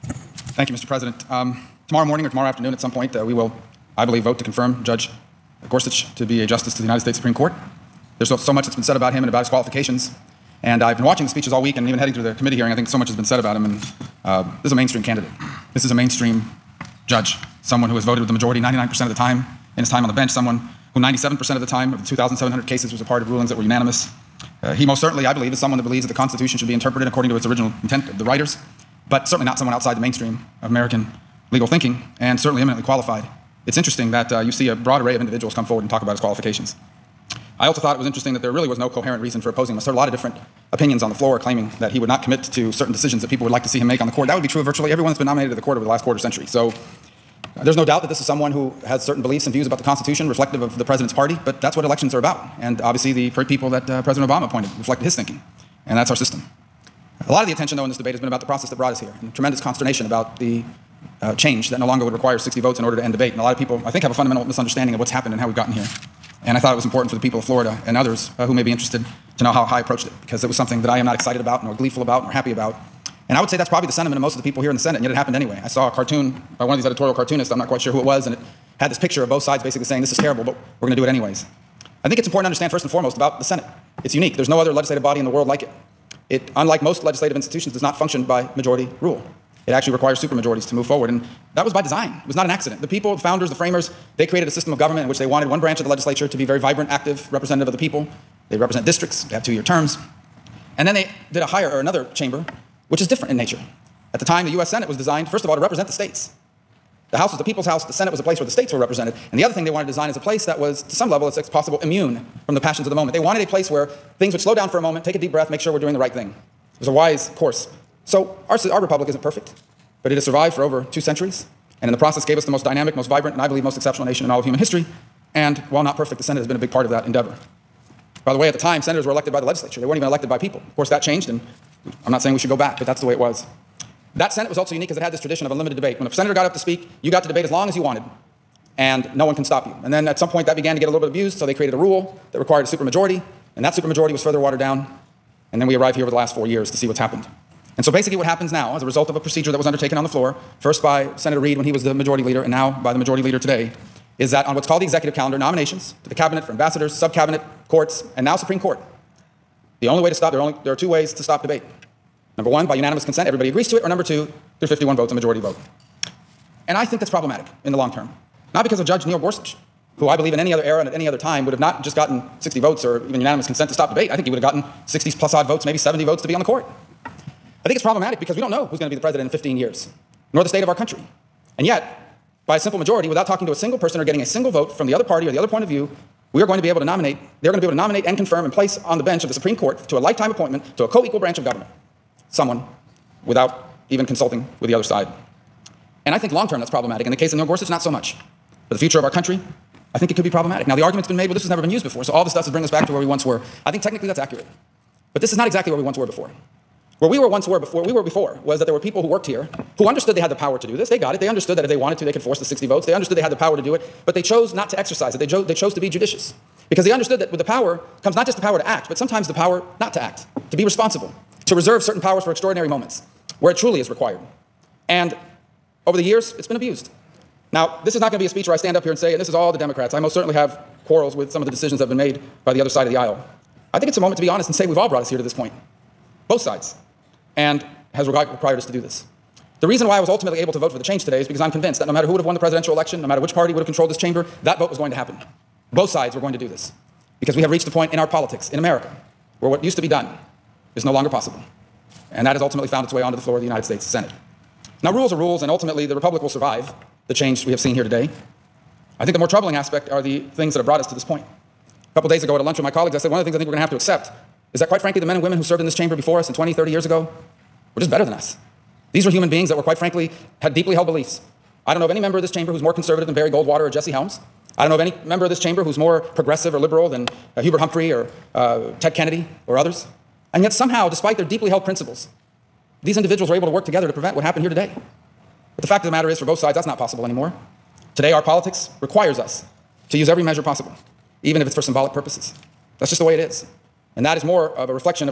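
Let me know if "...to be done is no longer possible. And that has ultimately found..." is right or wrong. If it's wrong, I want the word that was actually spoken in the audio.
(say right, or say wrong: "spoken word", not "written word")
right.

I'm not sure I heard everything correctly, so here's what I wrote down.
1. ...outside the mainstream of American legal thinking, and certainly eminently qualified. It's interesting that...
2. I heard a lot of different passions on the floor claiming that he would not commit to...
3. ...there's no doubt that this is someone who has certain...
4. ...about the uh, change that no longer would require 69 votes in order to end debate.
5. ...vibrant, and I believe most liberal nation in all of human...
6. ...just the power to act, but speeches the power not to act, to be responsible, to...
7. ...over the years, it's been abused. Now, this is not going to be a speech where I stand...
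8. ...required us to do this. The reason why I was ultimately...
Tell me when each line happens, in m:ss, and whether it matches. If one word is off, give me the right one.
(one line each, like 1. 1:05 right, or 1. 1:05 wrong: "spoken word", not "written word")
1. 0:29 right
2. 0:39 wrong: "opinions", not "passions"
3. 0:47 right
4. 1:00 wrong: "60", not "69"
5. 2:03 wrong: "exceptional", not "liberal"
6. 3:38 wrong: "sometimes", not "speeches"
7. 3:45 right
8. 3:58 right.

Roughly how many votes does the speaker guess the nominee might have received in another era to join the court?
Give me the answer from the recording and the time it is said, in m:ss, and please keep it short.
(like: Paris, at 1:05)
70, at 2:55.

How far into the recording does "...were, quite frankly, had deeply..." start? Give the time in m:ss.
4:29.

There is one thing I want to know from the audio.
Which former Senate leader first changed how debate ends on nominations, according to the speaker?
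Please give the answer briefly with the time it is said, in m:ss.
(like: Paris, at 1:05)
Senator Reid, at 2:31.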